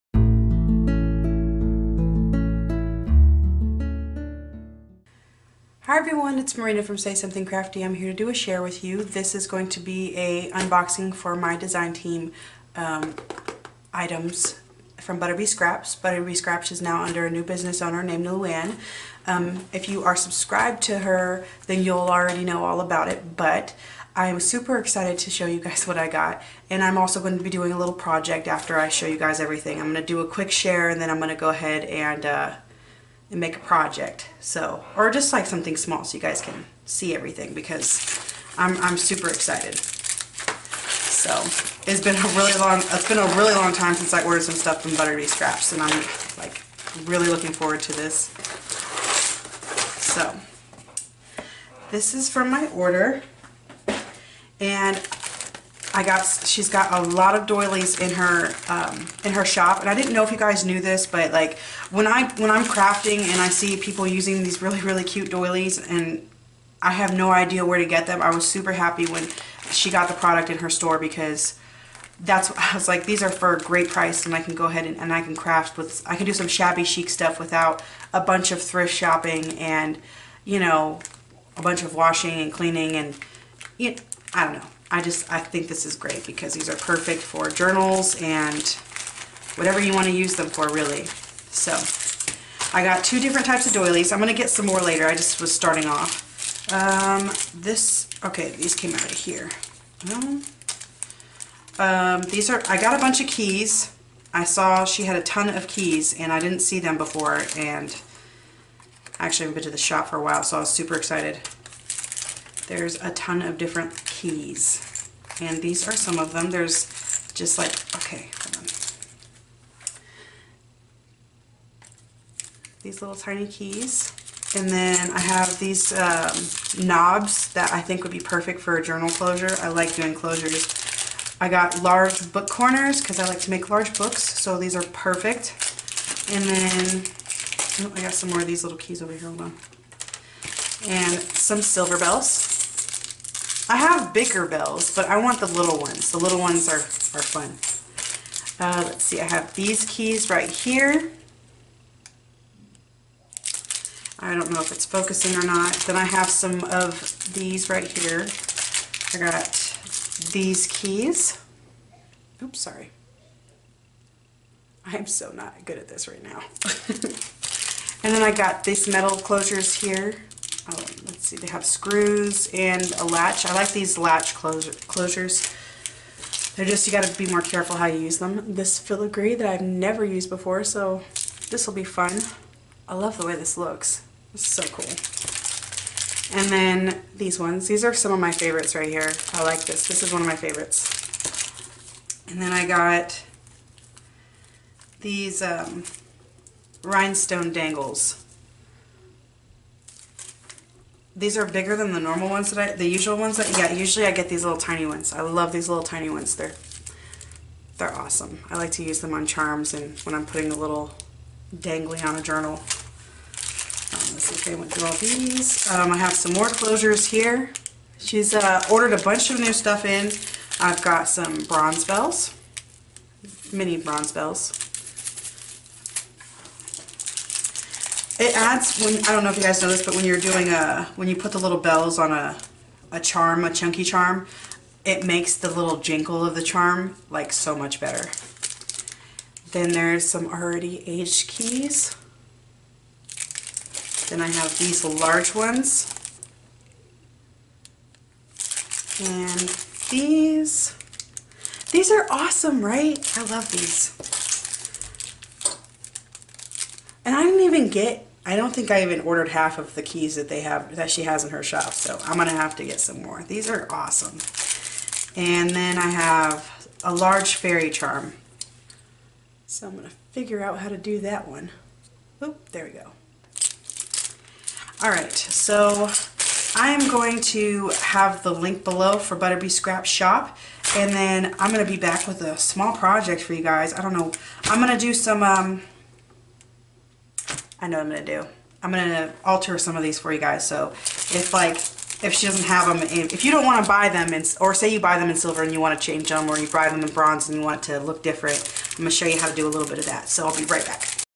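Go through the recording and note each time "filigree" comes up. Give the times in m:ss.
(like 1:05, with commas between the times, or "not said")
2:58.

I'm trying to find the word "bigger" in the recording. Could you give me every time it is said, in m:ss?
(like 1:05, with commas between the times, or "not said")
2:24, 3:21.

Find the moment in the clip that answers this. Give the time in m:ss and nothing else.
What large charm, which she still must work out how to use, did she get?
4:26.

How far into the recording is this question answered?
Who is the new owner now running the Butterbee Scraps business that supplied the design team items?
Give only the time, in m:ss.
0:18.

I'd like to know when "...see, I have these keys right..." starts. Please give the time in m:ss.
2:29.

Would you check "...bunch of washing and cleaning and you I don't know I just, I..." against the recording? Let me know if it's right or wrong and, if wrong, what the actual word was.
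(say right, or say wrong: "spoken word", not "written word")
right.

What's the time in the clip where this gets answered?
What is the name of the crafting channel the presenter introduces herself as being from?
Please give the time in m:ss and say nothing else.
0:06.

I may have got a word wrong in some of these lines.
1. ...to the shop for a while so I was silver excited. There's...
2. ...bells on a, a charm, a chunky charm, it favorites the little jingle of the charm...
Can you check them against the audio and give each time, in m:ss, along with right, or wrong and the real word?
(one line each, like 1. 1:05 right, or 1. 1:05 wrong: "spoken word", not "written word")
1. 1:49 wrong: "super", not "silver"
2. 3:51 wrong: "makes", not "favorites".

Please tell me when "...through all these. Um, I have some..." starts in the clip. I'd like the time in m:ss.
3:34.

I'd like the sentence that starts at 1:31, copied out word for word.
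So I got two different types of doilies.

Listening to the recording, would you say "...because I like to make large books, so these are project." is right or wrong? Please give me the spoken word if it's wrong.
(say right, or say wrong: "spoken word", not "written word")
wrong: "perfect", not "project".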